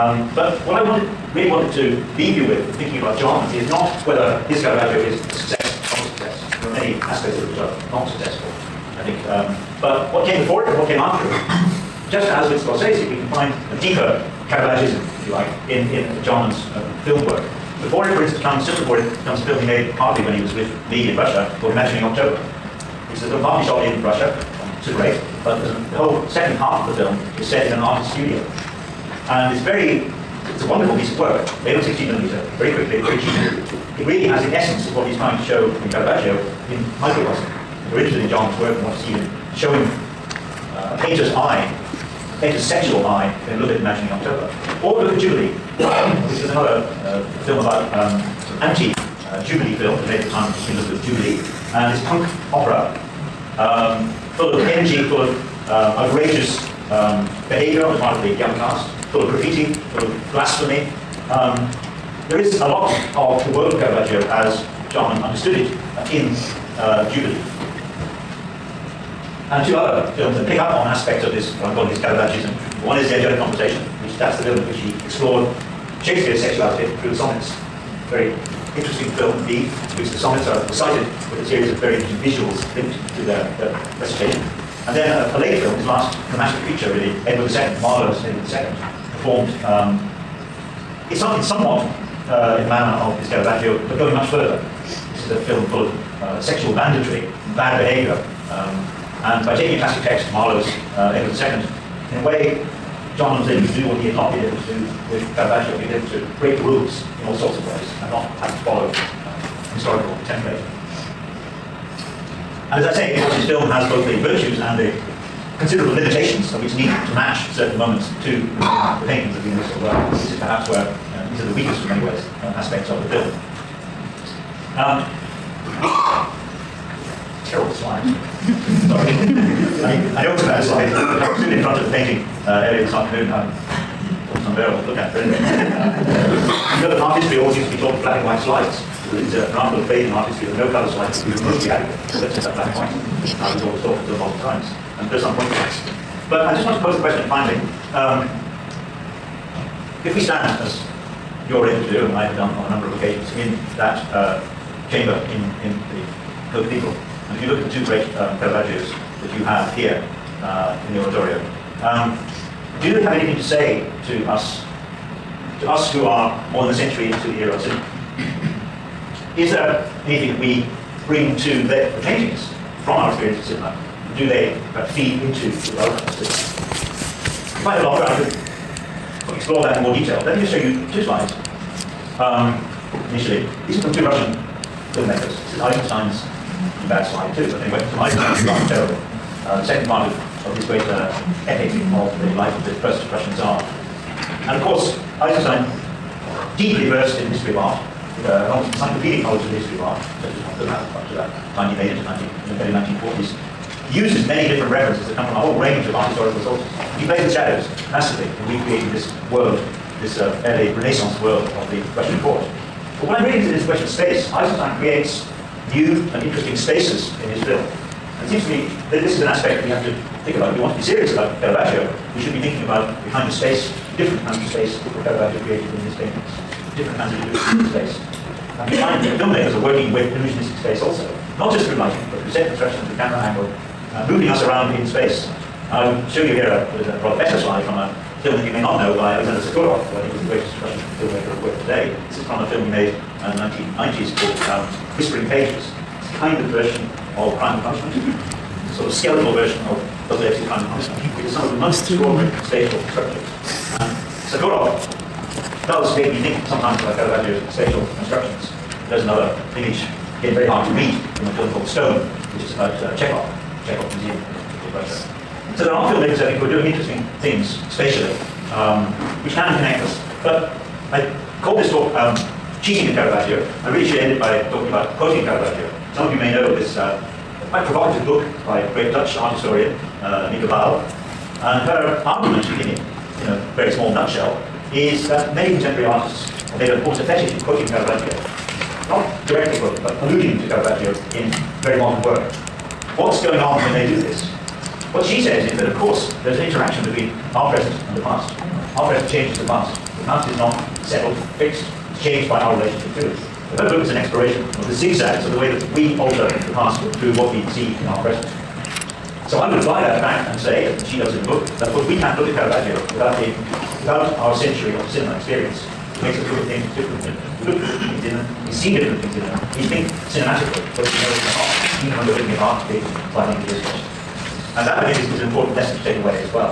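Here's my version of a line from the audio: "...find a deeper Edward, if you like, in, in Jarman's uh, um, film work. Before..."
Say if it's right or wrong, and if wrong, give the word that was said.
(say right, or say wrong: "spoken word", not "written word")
wrong: "Caravaggism", not "Edward".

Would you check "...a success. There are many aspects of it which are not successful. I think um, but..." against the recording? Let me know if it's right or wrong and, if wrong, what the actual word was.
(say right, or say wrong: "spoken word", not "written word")
right.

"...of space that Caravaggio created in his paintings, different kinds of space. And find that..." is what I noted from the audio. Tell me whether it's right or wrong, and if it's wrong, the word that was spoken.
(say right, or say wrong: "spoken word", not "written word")
right.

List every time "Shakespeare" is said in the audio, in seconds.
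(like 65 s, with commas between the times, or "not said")
76 s.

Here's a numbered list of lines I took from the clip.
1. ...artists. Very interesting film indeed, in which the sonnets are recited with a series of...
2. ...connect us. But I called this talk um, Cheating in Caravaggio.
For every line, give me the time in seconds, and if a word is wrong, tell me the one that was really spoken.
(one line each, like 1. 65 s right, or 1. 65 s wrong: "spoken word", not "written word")
1. 77 s wrong: "sonnets", not "artists"
2. 269 s right.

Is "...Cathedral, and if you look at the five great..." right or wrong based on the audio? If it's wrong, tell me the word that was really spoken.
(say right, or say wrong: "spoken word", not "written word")
wrong: "two", not "five".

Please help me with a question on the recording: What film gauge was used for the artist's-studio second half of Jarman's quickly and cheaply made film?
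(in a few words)
16 millimeter.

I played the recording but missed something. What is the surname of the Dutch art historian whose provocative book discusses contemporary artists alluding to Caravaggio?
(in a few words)
Bal.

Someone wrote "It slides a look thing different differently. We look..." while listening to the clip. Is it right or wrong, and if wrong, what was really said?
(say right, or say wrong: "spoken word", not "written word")
wrong: "makes", not "slides".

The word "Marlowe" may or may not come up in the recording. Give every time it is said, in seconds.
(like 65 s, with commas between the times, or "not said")
87 s, 100 s.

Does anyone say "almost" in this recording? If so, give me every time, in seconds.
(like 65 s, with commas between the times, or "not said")
134 s, 198 s, 286 s.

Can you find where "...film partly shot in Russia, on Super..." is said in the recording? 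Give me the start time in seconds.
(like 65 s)
23 s.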